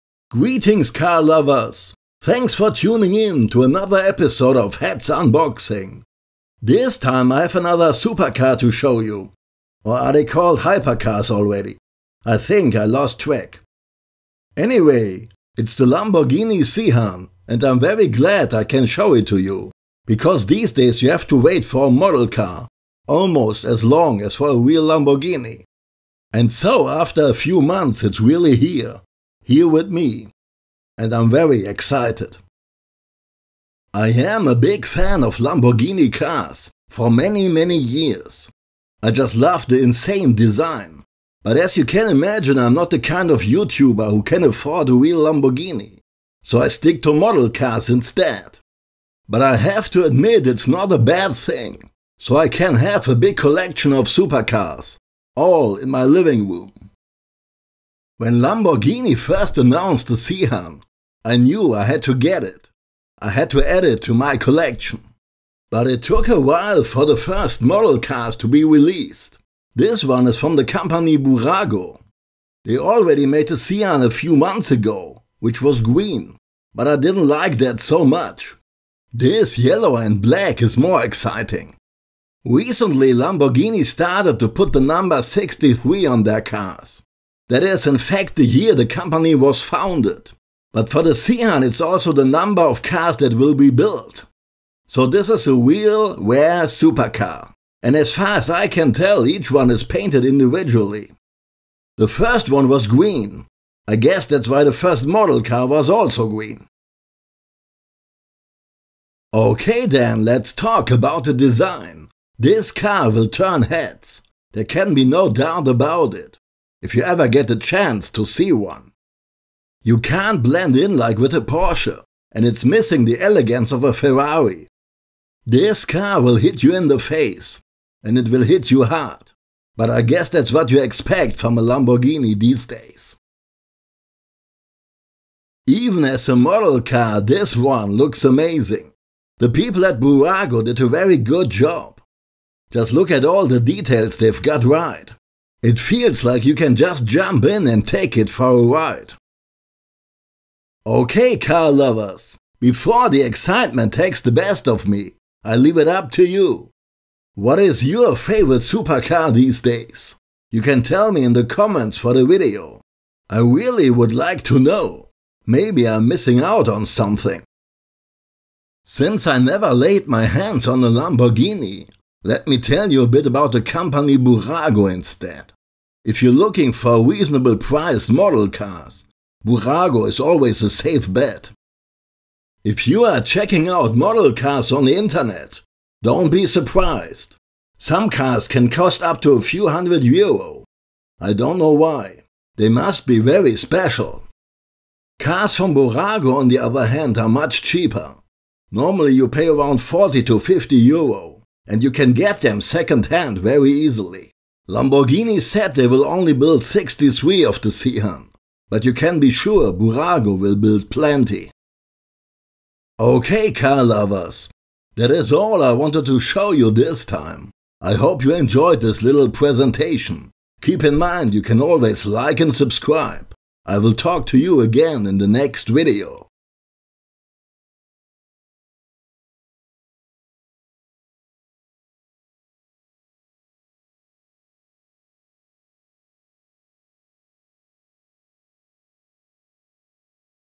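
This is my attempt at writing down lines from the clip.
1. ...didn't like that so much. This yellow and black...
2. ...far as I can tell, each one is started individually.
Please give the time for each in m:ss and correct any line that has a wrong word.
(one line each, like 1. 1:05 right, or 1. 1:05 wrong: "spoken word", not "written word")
1. 1:16 right
2. 1:38 wrong: "painted", not "started".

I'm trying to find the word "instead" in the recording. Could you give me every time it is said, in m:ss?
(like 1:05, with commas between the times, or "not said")
0:47, 2:54.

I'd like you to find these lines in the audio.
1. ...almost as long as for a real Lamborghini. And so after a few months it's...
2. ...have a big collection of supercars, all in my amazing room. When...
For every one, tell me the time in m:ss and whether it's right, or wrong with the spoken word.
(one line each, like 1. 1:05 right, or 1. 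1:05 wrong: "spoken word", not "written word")
1. 0:23 right
2. 0:52 wrong: "living", not "amazing".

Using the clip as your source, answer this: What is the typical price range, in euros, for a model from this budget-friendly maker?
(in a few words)
40 to 50 euro.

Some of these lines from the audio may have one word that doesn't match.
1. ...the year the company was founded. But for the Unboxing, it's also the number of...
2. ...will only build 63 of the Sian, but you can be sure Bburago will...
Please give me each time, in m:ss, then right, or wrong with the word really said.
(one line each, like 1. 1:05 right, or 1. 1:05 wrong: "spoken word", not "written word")
1. 1:28 wrong: "Sian", not "Unboxing"
2. 3:25 right.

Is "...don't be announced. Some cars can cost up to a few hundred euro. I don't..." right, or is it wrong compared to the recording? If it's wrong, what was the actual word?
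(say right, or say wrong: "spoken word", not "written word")
wrong: "surprised", not "announced".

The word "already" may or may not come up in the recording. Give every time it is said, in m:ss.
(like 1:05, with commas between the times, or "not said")
0:11, 1:12.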